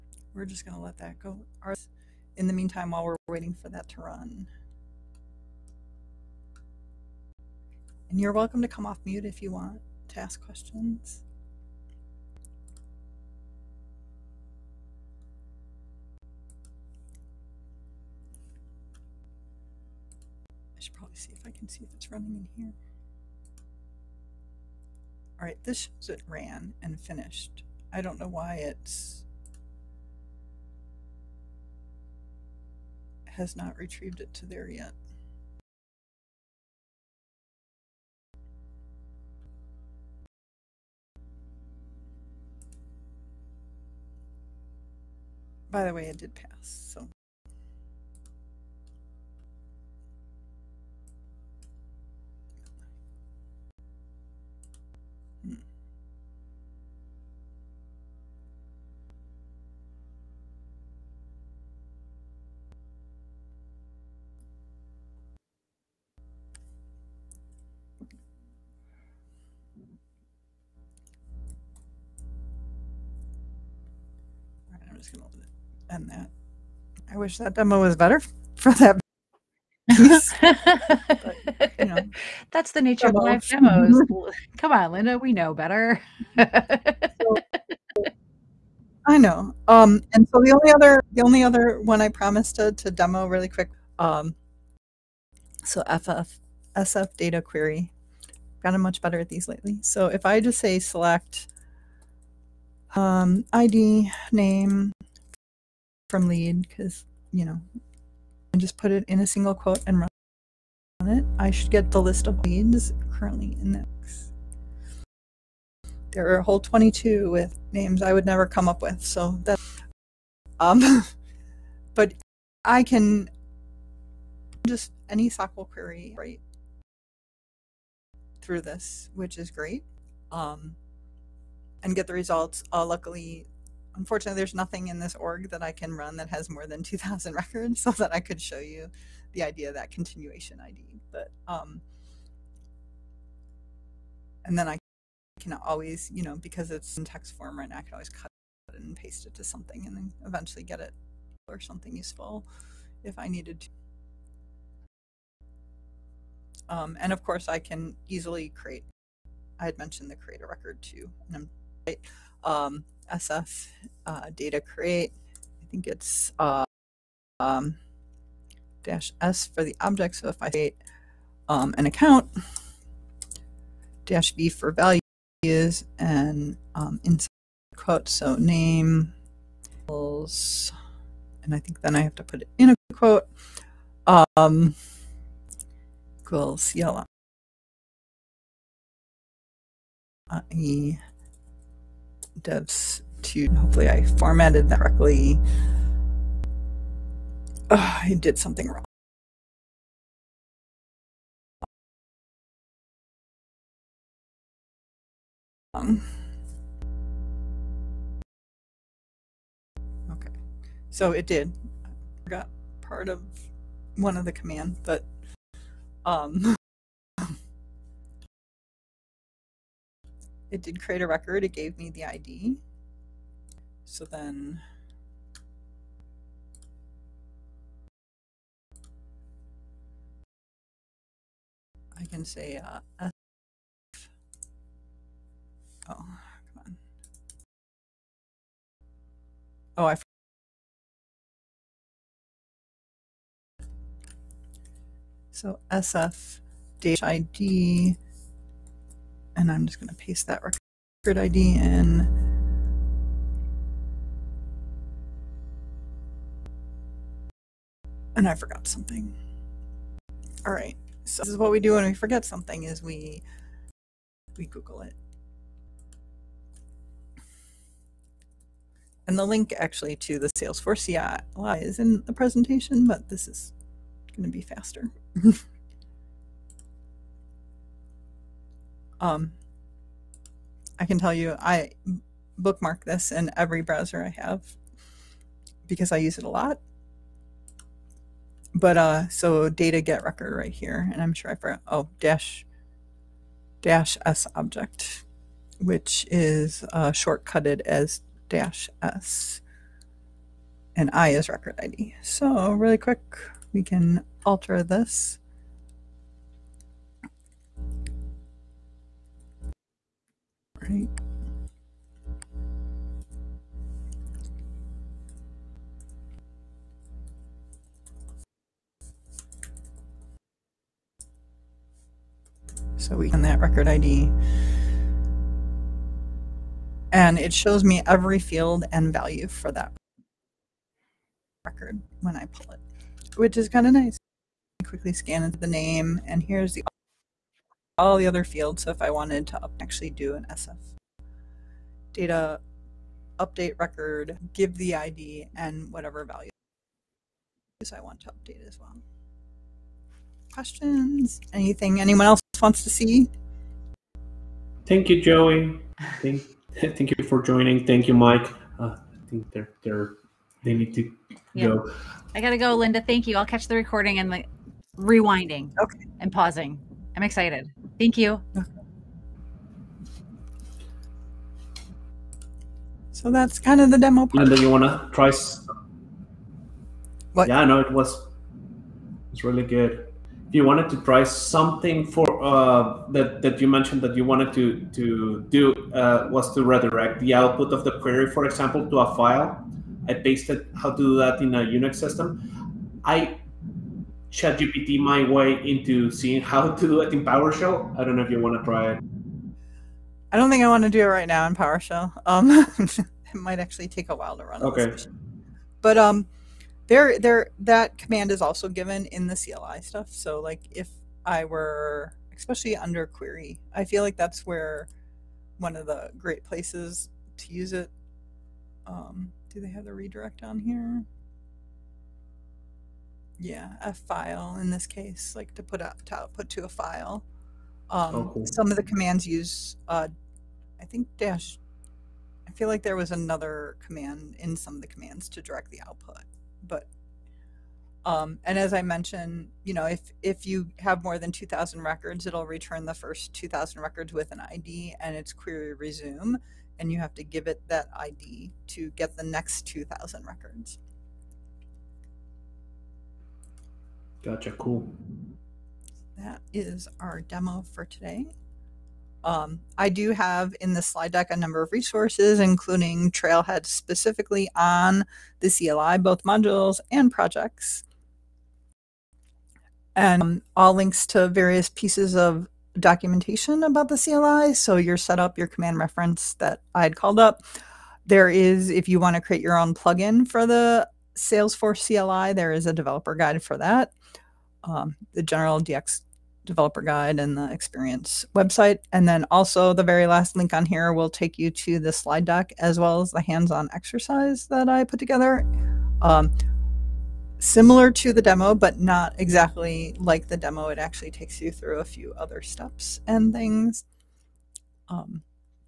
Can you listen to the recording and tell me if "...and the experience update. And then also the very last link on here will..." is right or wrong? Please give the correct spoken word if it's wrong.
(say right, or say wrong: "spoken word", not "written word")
wrong: "website", not "update".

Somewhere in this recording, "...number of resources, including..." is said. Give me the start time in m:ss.
7:41.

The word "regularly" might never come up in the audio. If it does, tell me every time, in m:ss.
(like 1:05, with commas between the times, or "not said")
not said.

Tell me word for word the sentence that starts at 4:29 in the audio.
And the link actually to the Salesforce CLI is in the presentation, but this is going to be faster.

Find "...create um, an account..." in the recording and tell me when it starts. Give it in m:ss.
2:50.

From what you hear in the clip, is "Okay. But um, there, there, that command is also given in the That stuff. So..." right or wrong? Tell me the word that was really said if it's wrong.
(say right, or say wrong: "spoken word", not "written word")
wrong: "CLI", not "That".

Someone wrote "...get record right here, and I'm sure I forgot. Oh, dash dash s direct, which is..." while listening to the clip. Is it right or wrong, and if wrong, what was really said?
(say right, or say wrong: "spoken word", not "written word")
wrong: "object", not "direct".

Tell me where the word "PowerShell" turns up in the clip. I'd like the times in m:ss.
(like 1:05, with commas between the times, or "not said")
6:37, 6:41.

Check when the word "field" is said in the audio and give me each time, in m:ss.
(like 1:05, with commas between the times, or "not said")
5:28, 5:38.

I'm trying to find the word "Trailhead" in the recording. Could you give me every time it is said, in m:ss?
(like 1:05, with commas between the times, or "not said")
7:42.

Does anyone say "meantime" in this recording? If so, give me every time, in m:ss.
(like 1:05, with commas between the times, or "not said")
0:02.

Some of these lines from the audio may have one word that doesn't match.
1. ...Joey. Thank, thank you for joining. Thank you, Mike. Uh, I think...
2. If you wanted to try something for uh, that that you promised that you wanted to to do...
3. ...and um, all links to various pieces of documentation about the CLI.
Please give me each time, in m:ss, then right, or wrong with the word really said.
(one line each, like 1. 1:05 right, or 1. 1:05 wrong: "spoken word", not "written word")
1. 5:55 right
2. 6:20 wrong: "mentioned", not "promised"
3. 7:49 right.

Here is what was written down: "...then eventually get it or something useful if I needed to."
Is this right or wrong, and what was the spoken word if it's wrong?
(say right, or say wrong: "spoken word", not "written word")
right.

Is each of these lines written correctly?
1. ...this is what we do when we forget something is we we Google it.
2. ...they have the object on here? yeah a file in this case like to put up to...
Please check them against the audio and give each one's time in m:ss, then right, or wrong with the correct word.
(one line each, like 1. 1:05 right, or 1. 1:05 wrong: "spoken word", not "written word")
1. 4:21 right
2. 6:59 wrong: "redirect", not "object".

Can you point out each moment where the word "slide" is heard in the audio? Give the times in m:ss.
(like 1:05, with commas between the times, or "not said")
7:40, 8:11.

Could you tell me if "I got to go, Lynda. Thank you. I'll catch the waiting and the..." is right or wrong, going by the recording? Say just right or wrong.
wrong.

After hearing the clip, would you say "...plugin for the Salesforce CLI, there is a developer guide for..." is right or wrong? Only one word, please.
right.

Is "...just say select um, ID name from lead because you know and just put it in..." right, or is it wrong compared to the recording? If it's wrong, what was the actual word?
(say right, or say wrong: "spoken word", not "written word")
right.